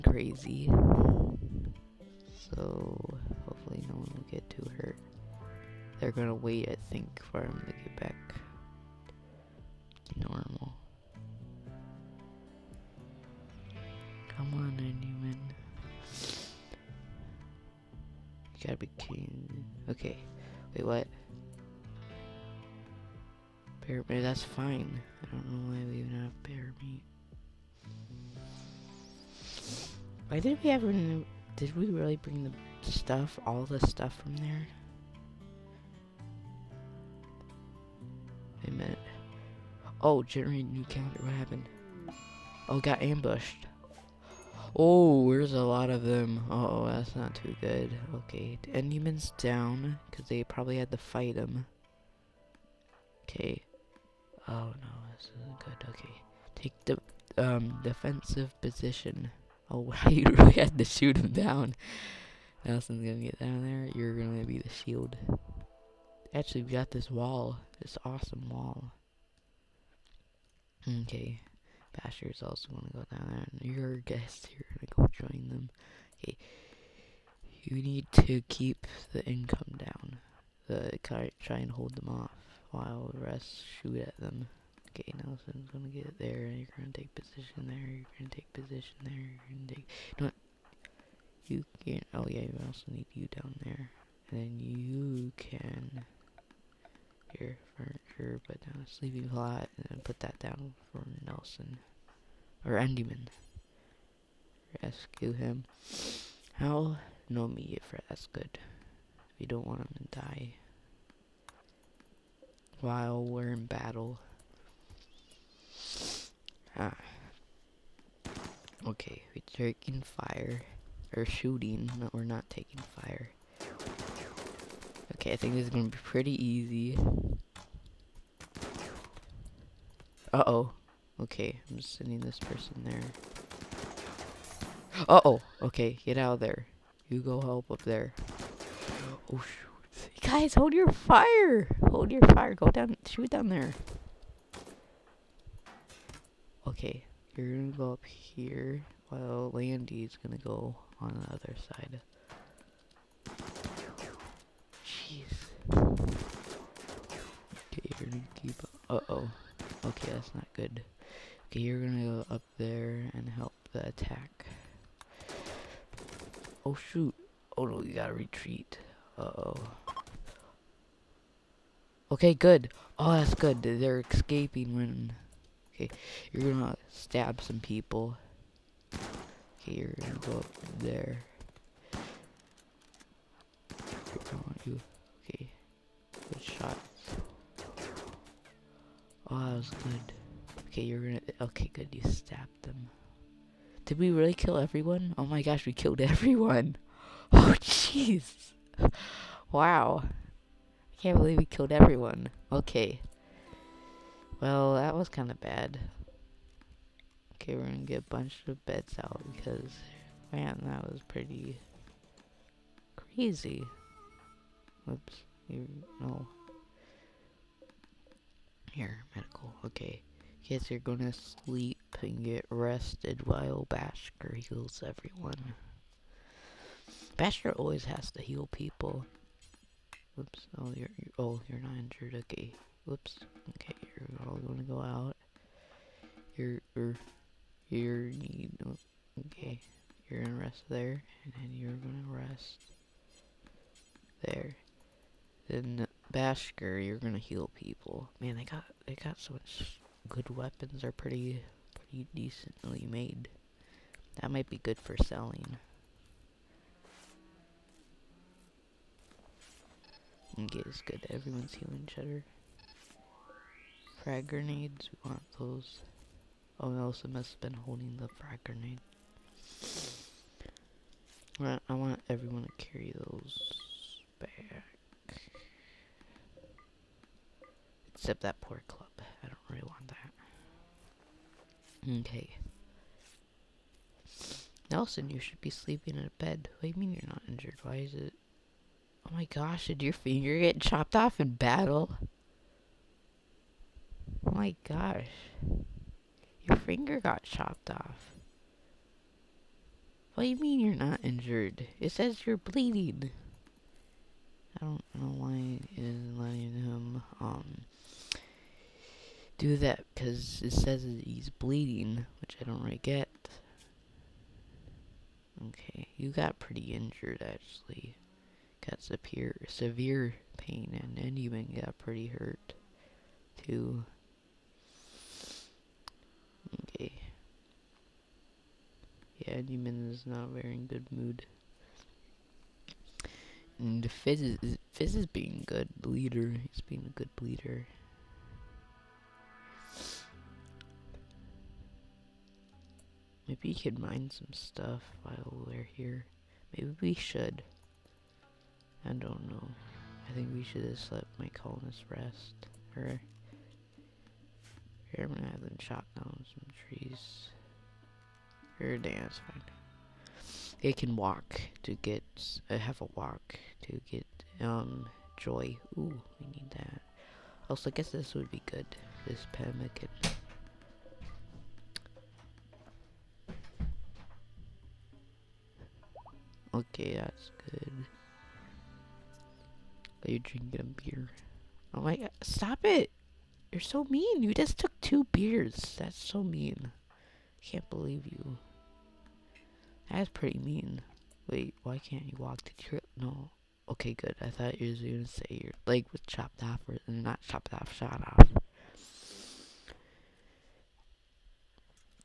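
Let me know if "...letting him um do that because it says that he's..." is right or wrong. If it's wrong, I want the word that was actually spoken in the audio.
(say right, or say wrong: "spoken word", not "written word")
right.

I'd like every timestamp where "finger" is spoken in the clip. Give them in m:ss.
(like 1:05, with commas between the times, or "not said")
4:49, 4:56.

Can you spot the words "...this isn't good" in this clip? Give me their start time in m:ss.
0:55.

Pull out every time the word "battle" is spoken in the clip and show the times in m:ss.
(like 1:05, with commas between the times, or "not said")
1:53, 4:51.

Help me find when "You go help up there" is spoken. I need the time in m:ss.
2:17.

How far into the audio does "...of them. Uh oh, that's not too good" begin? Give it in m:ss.
0:45.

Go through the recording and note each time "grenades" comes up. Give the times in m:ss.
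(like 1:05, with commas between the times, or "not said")
4:24, 4:28.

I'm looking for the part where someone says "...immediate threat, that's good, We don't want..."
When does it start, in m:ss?
1:47.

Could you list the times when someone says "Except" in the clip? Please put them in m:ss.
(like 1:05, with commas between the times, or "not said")
4:37.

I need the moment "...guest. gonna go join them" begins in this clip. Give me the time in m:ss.
1:13.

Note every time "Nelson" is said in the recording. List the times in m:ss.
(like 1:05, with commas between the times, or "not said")
1:02, 1:25, 1:41, 4:26, 4:44.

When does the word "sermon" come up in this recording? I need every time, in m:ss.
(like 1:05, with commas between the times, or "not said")
not said.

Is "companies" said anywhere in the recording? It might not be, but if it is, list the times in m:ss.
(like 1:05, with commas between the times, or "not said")
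not said.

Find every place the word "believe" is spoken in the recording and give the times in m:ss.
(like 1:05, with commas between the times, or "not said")
3:21, 6:27.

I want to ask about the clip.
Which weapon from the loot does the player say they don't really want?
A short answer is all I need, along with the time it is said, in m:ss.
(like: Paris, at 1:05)
Club, at 4:38.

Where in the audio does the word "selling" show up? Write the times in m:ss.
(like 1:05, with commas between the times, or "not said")
4:15.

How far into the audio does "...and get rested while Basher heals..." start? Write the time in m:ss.
3:41.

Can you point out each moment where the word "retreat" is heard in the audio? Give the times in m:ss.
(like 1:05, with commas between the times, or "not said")
2:48.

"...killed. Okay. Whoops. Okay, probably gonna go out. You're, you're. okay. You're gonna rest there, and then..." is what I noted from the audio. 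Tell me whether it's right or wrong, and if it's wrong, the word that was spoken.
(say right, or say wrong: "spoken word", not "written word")
wrong: "injured", not "killed".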